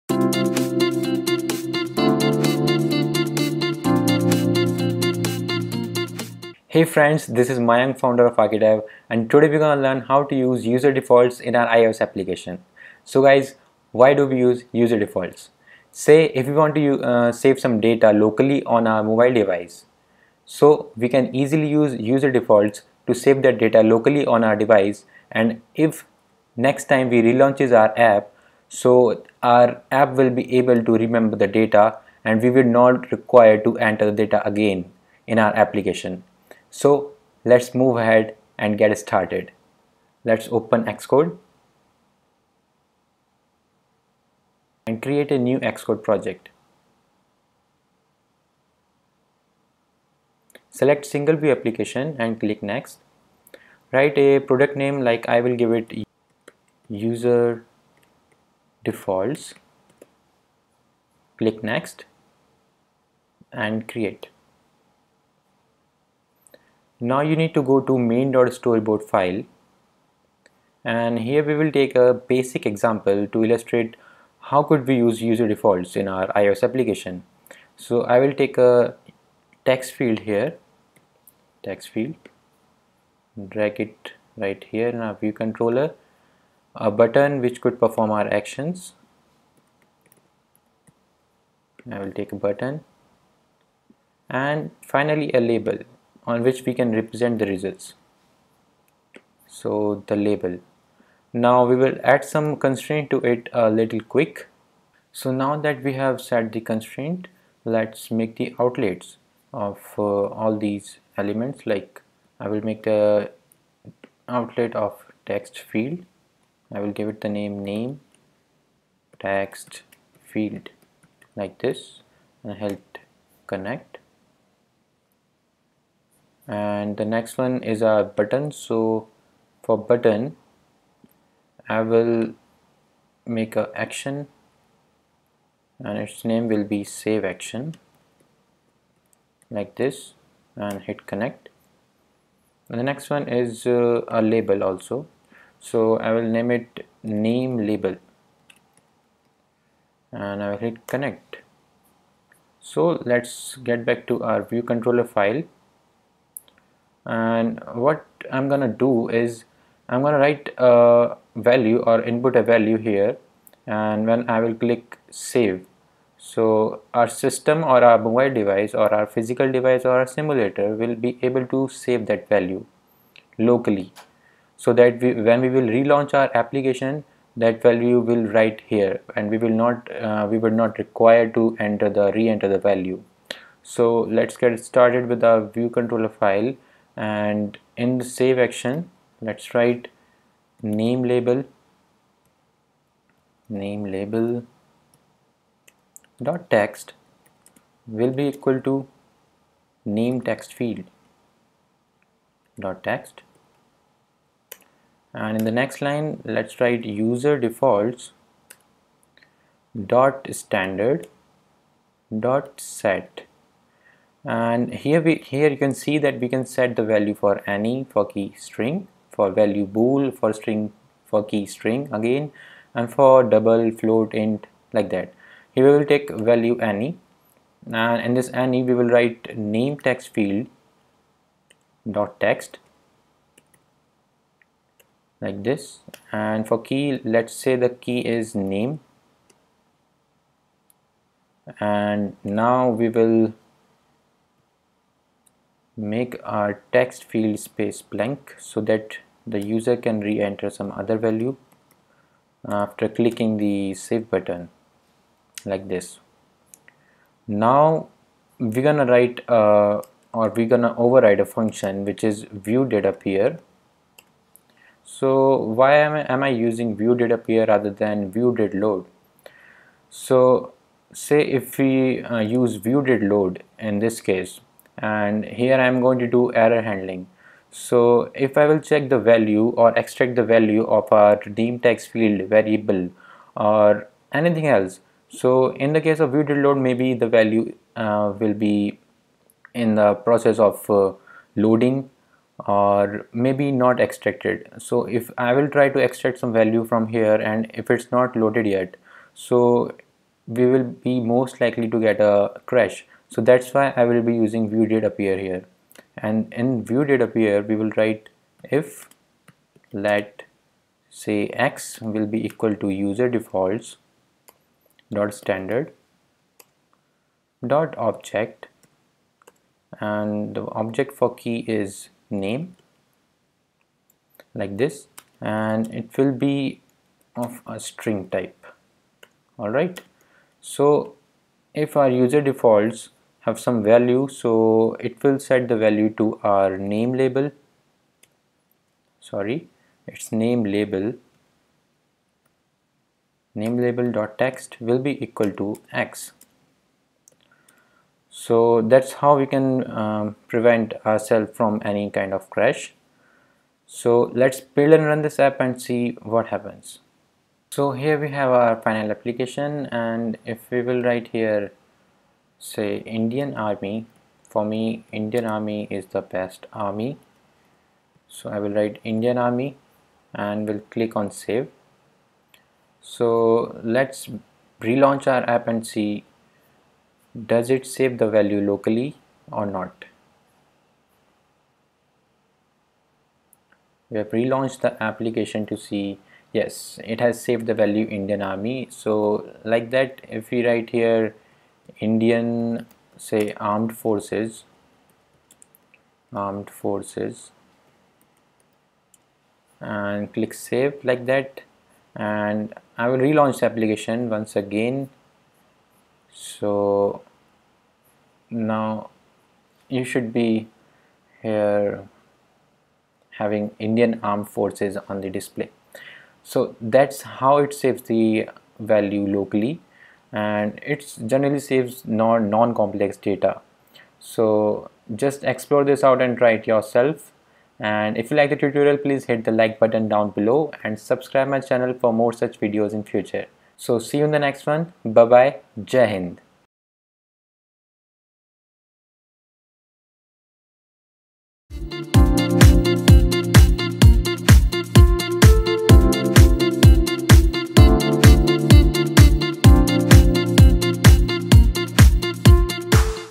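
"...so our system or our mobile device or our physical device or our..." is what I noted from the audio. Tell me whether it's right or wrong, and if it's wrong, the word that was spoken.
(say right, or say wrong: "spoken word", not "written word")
right.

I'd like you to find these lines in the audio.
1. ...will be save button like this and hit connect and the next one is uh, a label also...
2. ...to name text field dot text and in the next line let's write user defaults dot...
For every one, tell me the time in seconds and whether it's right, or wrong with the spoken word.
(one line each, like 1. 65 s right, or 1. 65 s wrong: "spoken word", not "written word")
1. 136 s wrong: "action", not "button"
2. 198 s right.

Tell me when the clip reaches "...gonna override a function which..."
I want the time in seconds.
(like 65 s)
260 s.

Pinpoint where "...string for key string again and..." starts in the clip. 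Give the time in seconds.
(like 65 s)
220 s.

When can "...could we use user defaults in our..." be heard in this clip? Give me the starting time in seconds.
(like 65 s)
74 s.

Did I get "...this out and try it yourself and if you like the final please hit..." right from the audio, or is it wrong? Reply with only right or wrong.
wrong.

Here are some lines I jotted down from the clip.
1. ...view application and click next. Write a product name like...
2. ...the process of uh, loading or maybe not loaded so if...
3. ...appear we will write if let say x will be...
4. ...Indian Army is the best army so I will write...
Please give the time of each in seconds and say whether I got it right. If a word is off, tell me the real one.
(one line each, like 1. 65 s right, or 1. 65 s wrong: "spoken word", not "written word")
1. 51 s right
2. 289 s wrong: "extracted", not "loaded"
3. 307 s right
4. 364 s right.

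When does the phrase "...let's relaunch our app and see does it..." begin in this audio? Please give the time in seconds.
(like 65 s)
373 s.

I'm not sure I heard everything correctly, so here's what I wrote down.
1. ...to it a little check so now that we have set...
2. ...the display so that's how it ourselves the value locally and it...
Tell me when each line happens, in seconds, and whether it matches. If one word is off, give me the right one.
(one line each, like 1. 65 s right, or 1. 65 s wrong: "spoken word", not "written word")
1. 103 s wrong: "quick", not "check"
2. 415 s wrong: "saves", not "ourselves".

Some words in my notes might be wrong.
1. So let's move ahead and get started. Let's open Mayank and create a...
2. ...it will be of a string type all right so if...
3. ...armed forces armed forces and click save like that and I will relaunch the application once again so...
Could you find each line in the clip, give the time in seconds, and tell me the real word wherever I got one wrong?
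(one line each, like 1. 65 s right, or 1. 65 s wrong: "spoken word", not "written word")
1. 36 s wrong: "Xcode", not "Mayank"
2. 325 s right
3. 393 s right.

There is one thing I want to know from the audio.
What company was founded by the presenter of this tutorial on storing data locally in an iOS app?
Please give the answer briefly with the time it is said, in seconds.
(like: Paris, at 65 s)
Archidev, at 8 s.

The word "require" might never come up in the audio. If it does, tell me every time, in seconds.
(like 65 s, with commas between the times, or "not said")
33 s, 180 s.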